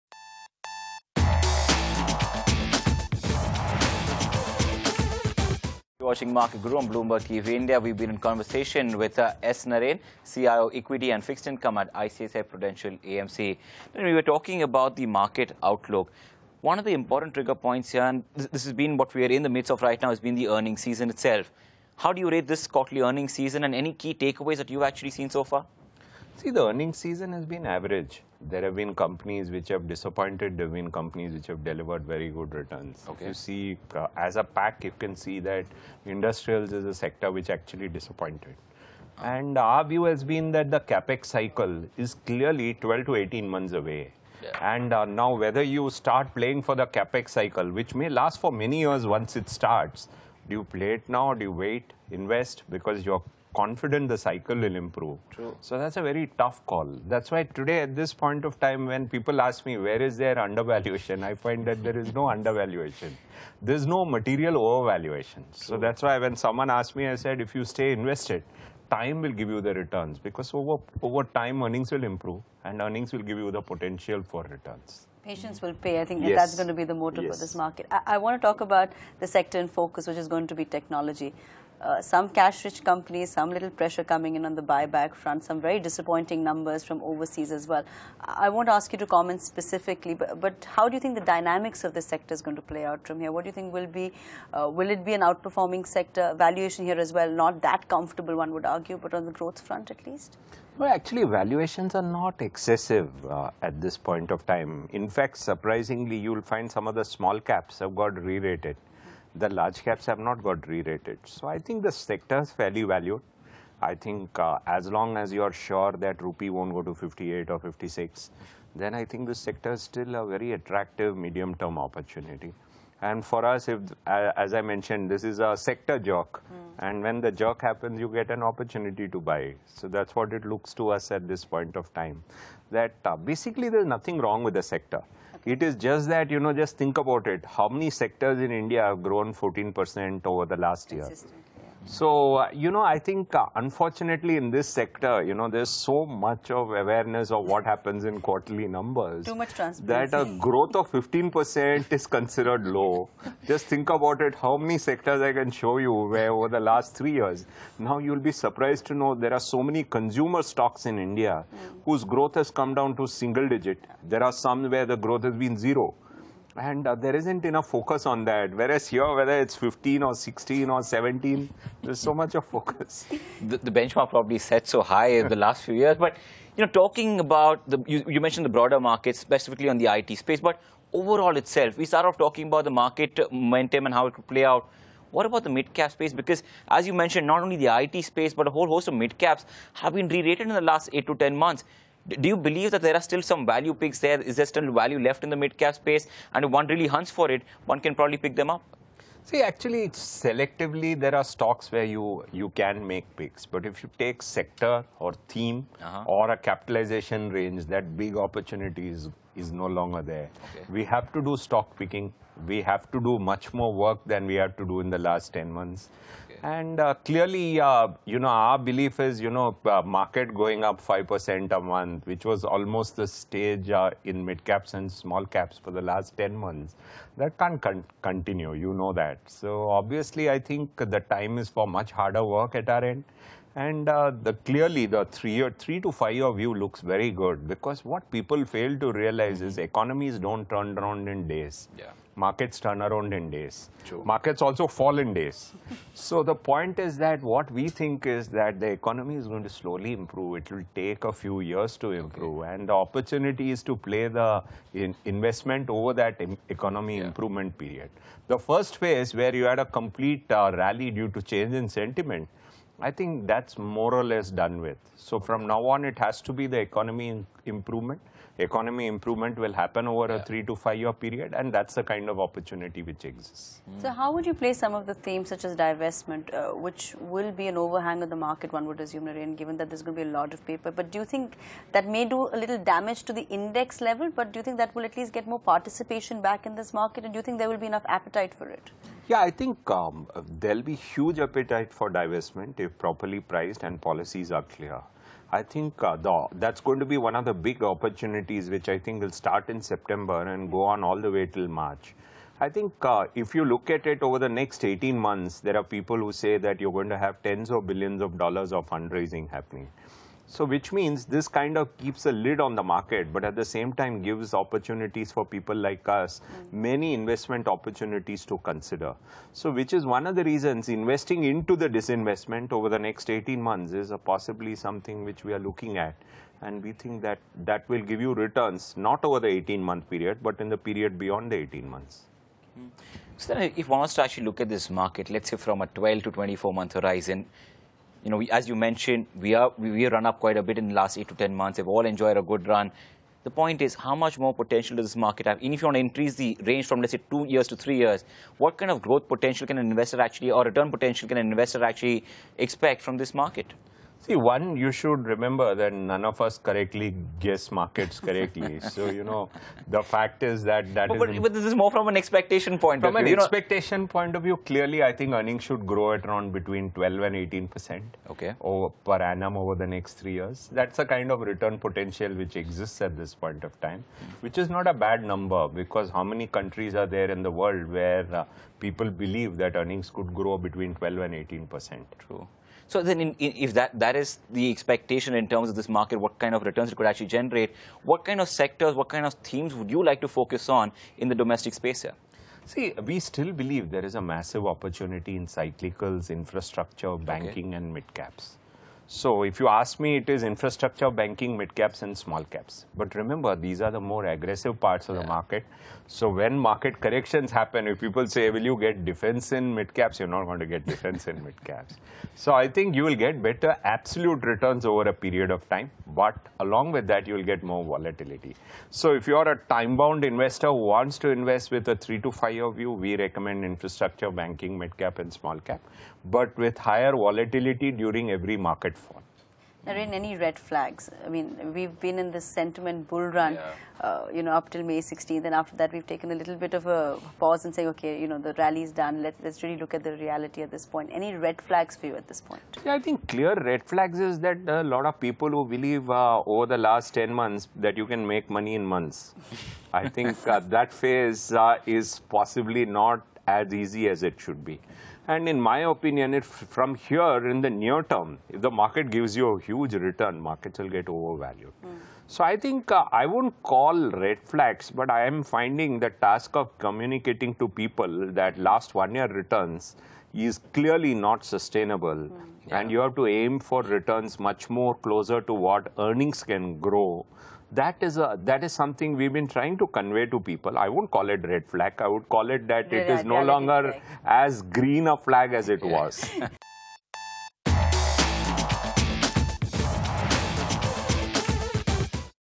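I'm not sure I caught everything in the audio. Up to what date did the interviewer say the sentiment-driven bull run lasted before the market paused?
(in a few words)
May 16.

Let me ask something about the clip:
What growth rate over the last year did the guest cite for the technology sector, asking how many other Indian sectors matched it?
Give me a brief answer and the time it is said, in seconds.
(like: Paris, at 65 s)
14%, at 139 s.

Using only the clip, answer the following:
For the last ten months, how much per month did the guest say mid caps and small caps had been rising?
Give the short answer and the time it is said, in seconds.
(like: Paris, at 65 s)
5%, at 220 s.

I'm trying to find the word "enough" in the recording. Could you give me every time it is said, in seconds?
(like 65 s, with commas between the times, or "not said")
167 s, 287 s.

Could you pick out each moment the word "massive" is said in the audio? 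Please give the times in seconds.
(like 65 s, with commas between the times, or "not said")
394 s.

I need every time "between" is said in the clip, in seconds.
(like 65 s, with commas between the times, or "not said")
366 s, 380 s.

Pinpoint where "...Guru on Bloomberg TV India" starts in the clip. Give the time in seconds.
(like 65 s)
6 s.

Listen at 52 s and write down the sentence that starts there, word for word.
Because you're confident the cycle will improve.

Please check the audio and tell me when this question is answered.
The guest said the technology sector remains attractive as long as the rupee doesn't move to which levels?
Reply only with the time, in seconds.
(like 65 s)
116 s.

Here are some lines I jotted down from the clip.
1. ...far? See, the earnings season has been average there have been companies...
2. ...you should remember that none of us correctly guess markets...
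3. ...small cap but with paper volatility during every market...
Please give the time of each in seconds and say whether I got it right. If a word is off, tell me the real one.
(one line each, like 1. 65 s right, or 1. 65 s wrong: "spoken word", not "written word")
1. 25 s right
2. 354 s right
3. 425 s wrong: "higher", not "paper".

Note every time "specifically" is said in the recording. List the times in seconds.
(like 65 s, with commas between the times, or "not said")
89 s, 179 s.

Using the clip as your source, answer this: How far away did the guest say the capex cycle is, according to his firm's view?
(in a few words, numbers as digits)
12 to 18 months.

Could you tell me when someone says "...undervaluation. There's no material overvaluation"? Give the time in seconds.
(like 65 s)
62 s.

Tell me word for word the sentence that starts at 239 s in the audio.
economies don't turn around in days.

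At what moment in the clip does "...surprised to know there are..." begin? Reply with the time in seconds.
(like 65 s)
158 s.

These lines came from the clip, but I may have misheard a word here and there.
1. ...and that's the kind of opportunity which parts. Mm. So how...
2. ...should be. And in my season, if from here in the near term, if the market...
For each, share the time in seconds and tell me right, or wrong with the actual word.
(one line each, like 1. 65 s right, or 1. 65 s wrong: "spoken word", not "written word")
1. 271 s wrong: "exists", not "parts"
2. 454 s wrong: "opinion", not "season".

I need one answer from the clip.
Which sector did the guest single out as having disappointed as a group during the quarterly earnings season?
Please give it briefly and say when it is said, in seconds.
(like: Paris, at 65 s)
Industrials, at 36 s.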